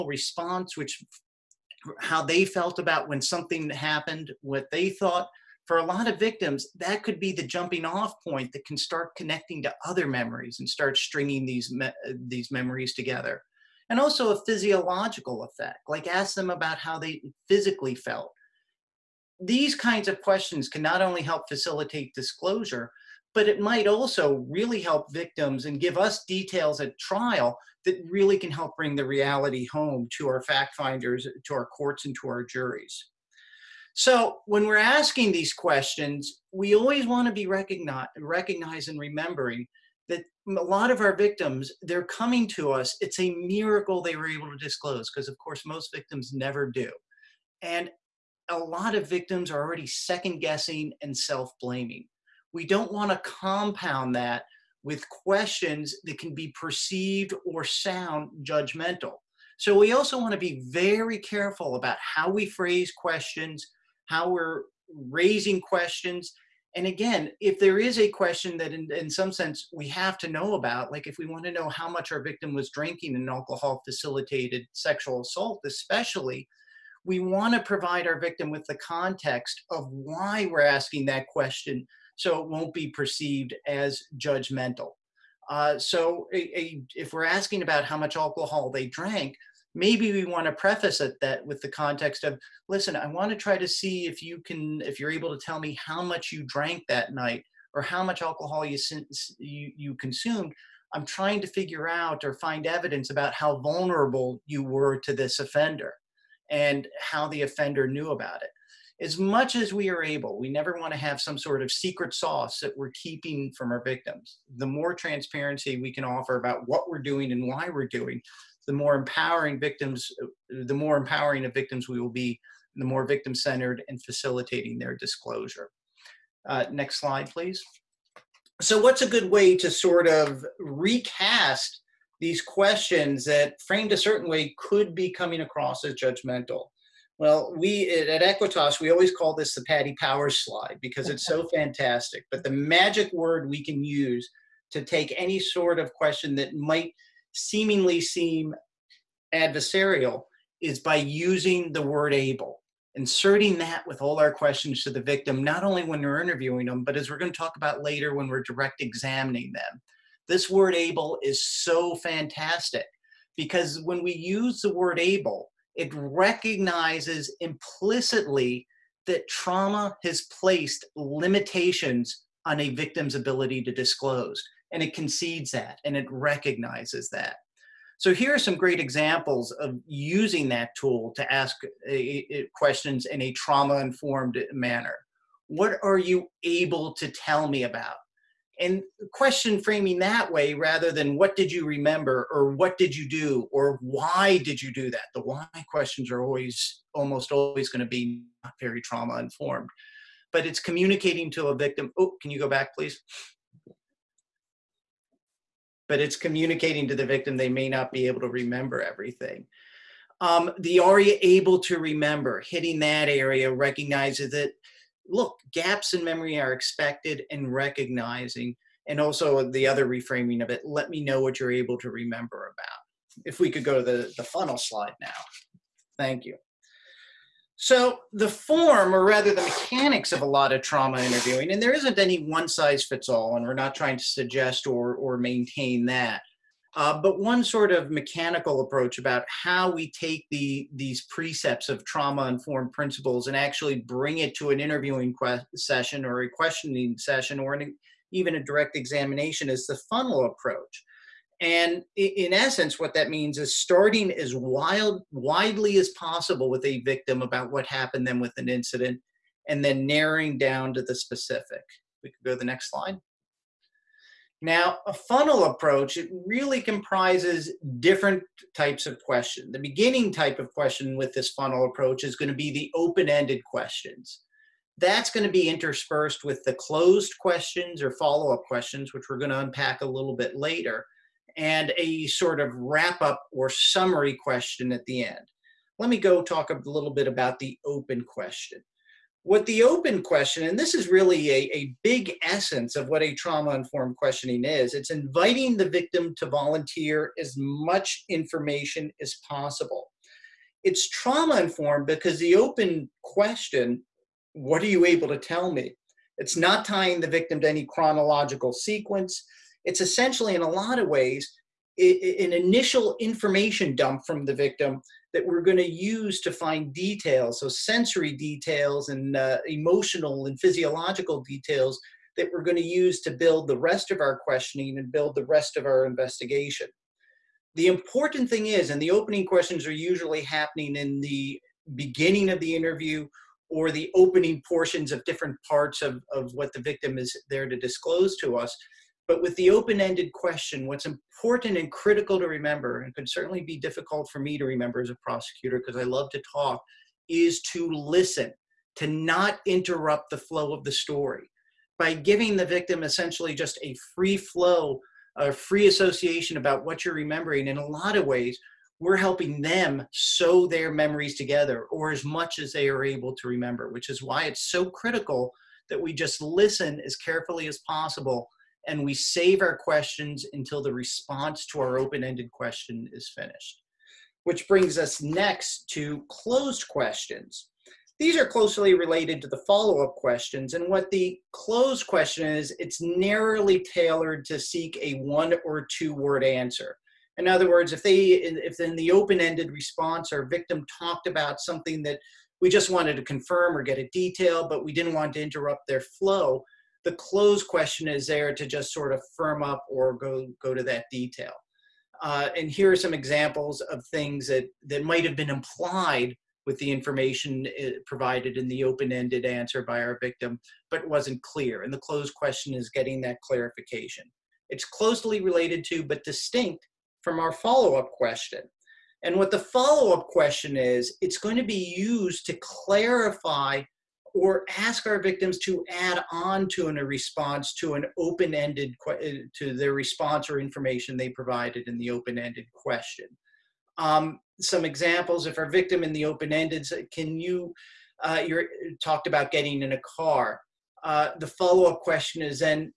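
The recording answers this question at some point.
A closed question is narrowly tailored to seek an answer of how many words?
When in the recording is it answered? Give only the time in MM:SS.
06:24.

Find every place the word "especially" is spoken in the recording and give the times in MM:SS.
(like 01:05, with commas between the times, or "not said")
01:15.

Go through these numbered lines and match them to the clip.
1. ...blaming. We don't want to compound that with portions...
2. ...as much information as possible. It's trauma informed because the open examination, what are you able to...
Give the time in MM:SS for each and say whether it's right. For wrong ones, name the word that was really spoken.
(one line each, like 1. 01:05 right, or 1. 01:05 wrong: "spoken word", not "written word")
1. 00:51 wrong: "questions", not "portions"
2. 04:57 wrong: "question", not "examination".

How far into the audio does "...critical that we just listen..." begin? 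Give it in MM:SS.
06:04.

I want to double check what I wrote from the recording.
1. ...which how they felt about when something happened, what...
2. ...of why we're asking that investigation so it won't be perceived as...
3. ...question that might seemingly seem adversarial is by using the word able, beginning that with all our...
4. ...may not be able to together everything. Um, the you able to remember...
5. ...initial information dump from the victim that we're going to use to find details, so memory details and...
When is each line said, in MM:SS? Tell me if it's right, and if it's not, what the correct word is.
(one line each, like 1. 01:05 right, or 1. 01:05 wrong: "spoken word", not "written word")
1. 00:00 right
2. 01:19 wrong: "question", not "investigation"
3. 02:25 wrong: "inserting", not "beginning"
4. 03:27 wrong: "remember", not "together"
5. 05:12 wrong: "sensory", not "memory".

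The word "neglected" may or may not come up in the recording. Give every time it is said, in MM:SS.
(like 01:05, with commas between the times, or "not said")
not said.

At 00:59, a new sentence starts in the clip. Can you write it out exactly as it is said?
So we also want to be very careful about how we phrase questions, how we're raising questions.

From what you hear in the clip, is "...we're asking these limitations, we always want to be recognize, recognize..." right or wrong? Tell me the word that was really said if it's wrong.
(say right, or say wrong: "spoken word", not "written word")
wrong: "questions", not "limitations".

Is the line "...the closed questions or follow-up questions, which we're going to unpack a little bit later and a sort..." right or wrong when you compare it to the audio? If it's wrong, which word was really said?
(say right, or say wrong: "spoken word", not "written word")
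right.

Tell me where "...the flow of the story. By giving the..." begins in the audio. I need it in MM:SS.
05:50.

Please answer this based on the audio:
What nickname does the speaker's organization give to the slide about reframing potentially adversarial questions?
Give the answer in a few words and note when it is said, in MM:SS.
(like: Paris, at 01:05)
The Patty Powers slide, at 02:19.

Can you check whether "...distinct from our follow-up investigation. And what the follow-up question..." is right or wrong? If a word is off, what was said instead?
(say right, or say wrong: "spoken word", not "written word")
wrong: "question", not "investigation".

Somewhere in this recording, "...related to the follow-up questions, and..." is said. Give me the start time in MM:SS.
06:18.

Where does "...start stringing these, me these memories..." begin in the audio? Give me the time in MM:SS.
00:10.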